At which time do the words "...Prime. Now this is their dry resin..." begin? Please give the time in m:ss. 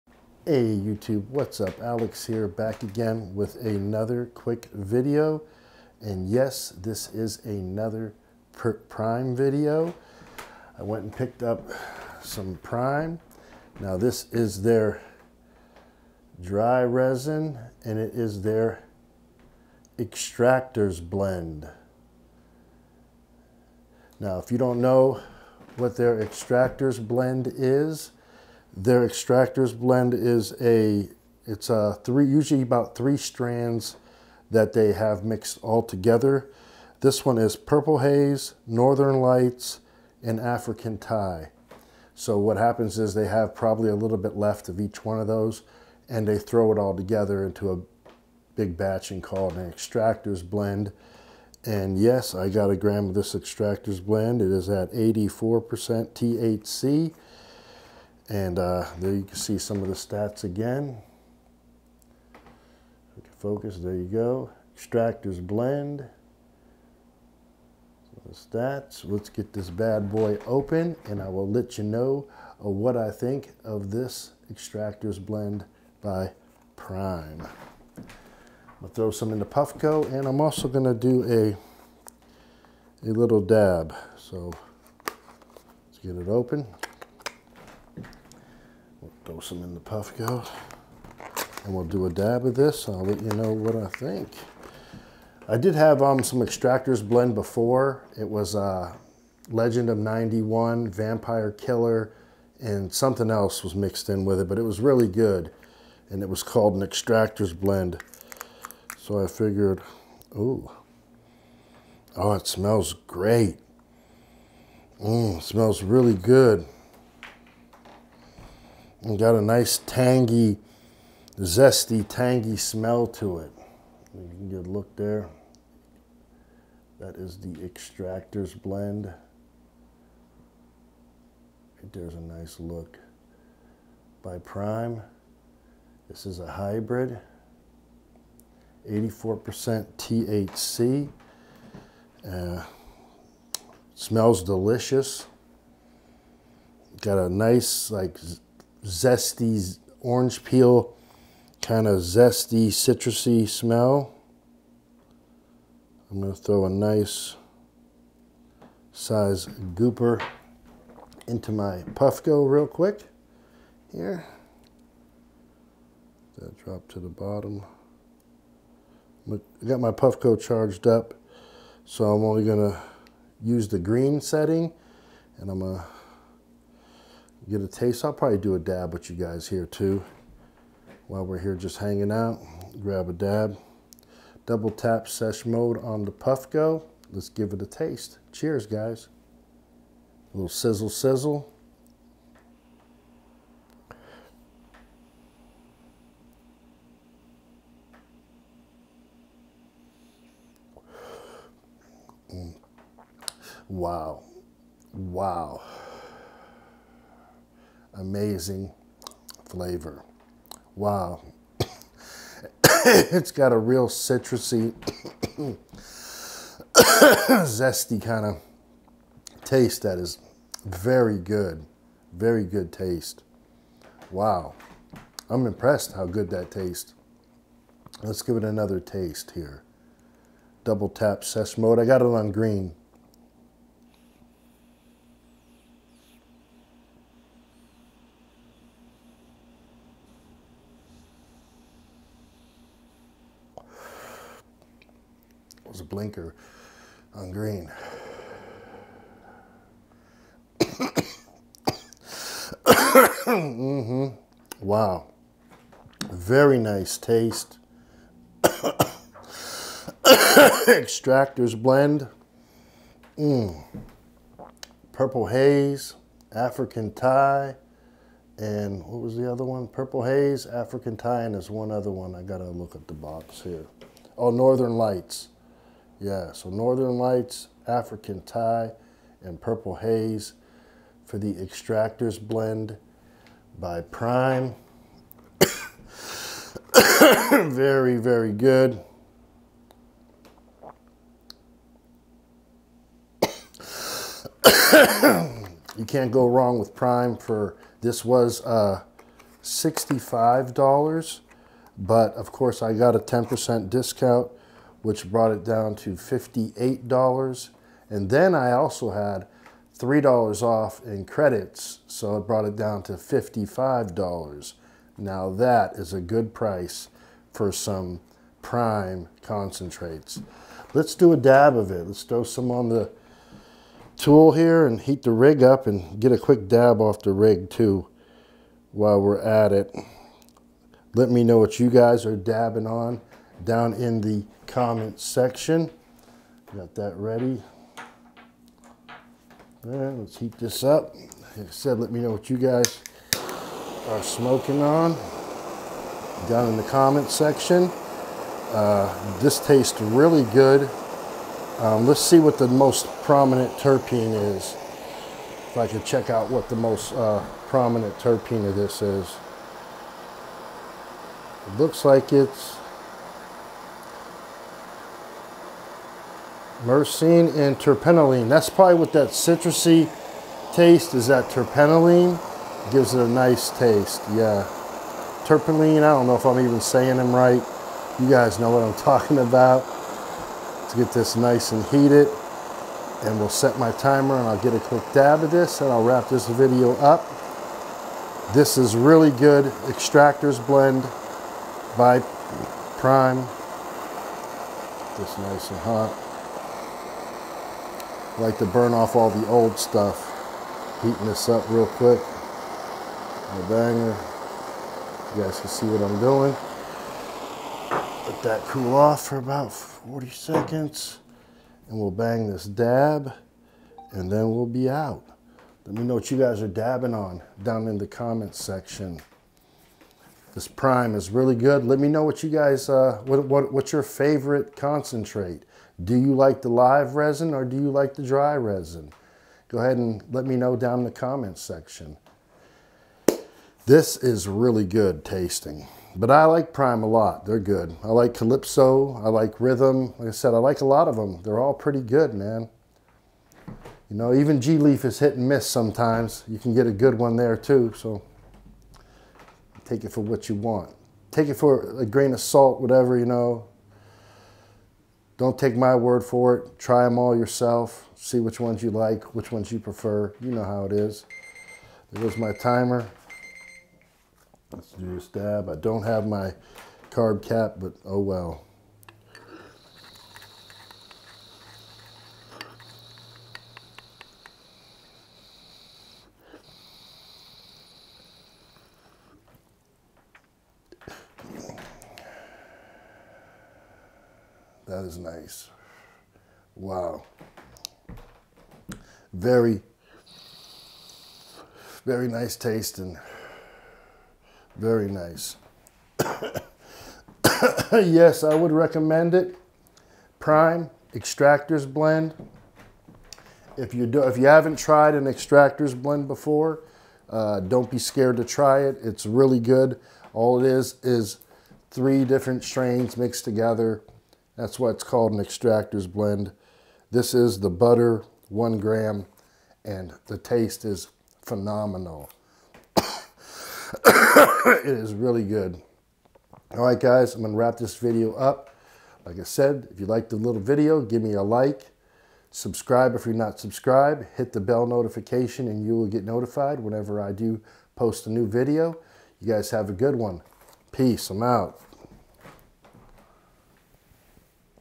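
0:12.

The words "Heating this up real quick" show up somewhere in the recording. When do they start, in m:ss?
6:40.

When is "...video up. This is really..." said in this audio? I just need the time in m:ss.
6:26.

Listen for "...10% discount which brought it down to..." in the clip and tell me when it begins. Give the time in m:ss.
5:02.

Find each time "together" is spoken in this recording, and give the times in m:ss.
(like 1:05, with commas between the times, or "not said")
0:35, 0:46, 8:33.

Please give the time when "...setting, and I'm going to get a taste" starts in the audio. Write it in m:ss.
2:54.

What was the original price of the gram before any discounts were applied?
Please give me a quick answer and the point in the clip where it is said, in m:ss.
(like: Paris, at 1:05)
$65, at 4:59.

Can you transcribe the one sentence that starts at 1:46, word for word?
And it was called an extractors blend.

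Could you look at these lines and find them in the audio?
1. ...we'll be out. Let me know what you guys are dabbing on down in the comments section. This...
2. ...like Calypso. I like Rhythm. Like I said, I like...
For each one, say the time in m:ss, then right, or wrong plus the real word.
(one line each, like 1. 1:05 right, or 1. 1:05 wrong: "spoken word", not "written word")
1. 6:54 right
2. 7:17 right.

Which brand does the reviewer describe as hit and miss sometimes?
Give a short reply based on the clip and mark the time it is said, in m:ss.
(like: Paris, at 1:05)
G-Leaf, at 7:24.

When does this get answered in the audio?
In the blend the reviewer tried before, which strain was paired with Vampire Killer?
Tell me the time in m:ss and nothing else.
1:39.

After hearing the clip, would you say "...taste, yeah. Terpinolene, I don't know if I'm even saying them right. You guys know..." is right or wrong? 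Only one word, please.
right.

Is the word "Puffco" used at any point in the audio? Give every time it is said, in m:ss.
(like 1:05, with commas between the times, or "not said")
1:19, 1:29, 2:41, 2:49, 3:06.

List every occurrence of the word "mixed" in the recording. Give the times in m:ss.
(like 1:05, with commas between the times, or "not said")
0:35, 1:43, 8:32.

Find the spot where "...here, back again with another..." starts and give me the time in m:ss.
0:02.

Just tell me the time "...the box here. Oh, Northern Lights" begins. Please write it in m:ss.
4:32.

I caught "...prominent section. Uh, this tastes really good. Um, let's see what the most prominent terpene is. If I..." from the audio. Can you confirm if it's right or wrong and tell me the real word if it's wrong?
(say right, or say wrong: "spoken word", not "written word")
wrong: "comment", not "prominent".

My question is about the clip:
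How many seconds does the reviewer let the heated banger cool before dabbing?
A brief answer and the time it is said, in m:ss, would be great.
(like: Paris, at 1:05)
40 seconds, at 6:49.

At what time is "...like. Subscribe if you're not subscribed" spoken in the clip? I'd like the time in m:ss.
8:51.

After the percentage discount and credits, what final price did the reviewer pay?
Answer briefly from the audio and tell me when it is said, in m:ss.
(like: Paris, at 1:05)
$55, at 5:12.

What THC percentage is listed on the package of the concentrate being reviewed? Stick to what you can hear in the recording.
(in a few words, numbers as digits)
84%.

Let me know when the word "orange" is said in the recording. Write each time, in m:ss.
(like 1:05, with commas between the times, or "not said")
2:29.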